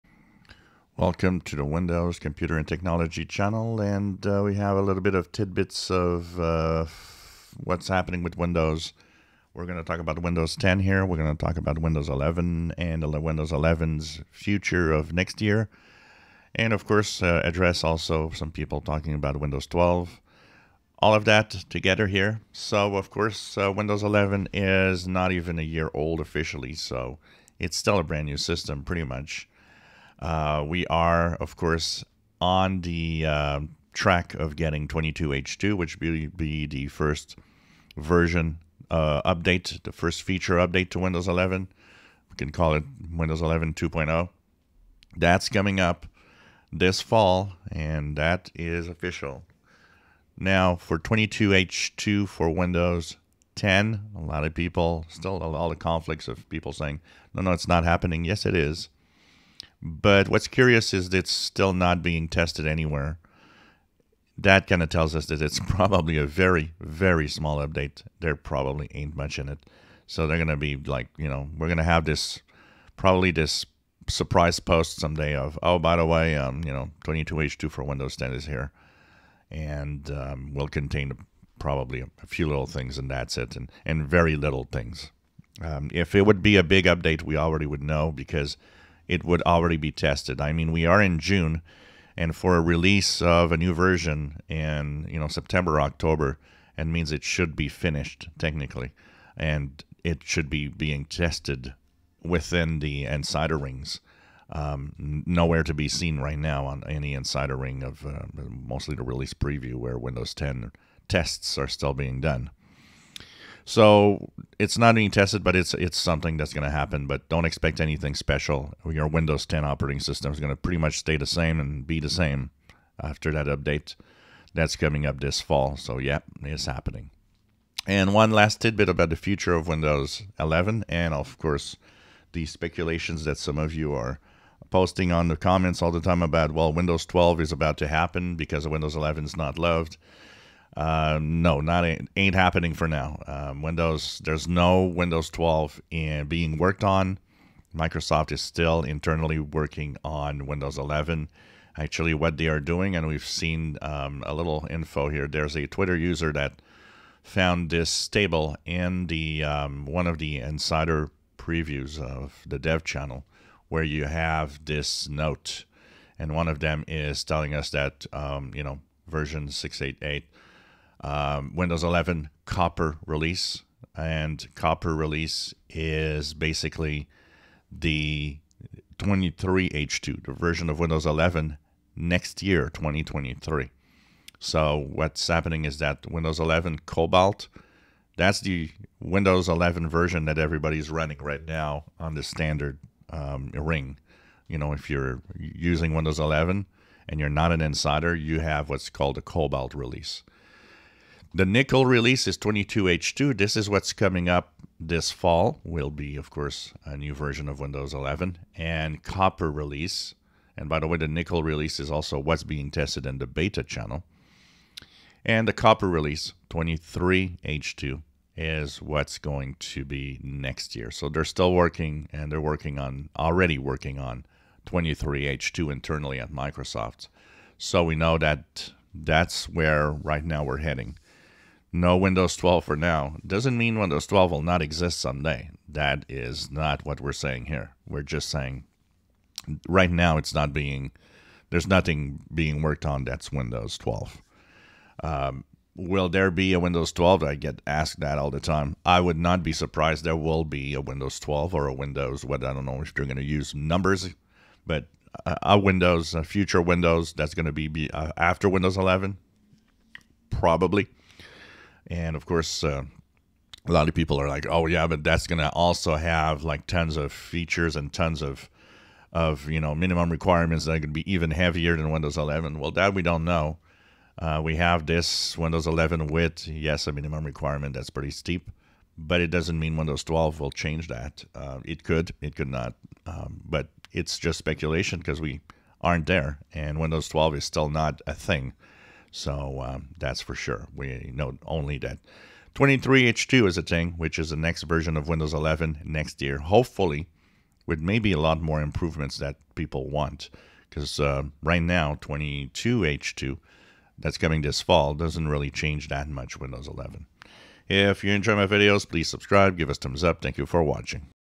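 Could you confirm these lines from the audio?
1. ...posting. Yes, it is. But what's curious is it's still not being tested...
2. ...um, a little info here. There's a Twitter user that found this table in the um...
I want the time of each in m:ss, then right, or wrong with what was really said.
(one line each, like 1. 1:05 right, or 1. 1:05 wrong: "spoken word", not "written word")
1. 0:57 wrong: "happening", not "posting"
2. 2:33 right.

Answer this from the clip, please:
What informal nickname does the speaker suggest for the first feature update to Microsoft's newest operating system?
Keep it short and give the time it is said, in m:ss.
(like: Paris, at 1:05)
Windows 11 2.0, at 0:43.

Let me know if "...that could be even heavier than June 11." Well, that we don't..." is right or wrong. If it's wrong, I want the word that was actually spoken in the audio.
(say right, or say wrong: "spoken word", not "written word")
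wrong: "Windows", not "June".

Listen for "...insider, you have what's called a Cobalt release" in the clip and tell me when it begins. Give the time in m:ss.
3:17.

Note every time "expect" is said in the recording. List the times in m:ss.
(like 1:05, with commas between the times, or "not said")
1:57.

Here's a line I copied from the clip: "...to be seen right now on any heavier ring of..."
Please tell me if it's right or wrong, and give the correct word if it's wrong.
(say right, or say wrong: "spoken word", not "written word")
wrong: "insider", not "heavier".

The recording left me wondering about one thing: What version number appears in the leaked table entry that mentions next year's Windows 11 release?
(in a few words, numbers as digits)
688.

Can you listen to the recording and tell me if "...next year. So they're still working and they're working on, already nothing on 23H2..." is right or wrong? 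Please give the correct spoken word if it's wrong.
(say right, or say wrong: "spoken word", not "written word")
wrong: "working", not "nothing".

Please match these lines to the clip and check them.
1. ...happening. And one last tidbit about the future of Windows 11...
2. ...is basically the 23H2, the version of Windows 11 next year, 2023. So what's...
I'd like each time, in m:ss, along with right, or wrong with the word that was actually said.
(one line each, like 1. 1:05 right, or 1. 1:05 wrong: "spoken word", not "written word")
1. 2:06 right
2. 2:55 right.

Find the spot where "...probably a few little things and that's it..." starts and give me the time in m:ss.
1:21.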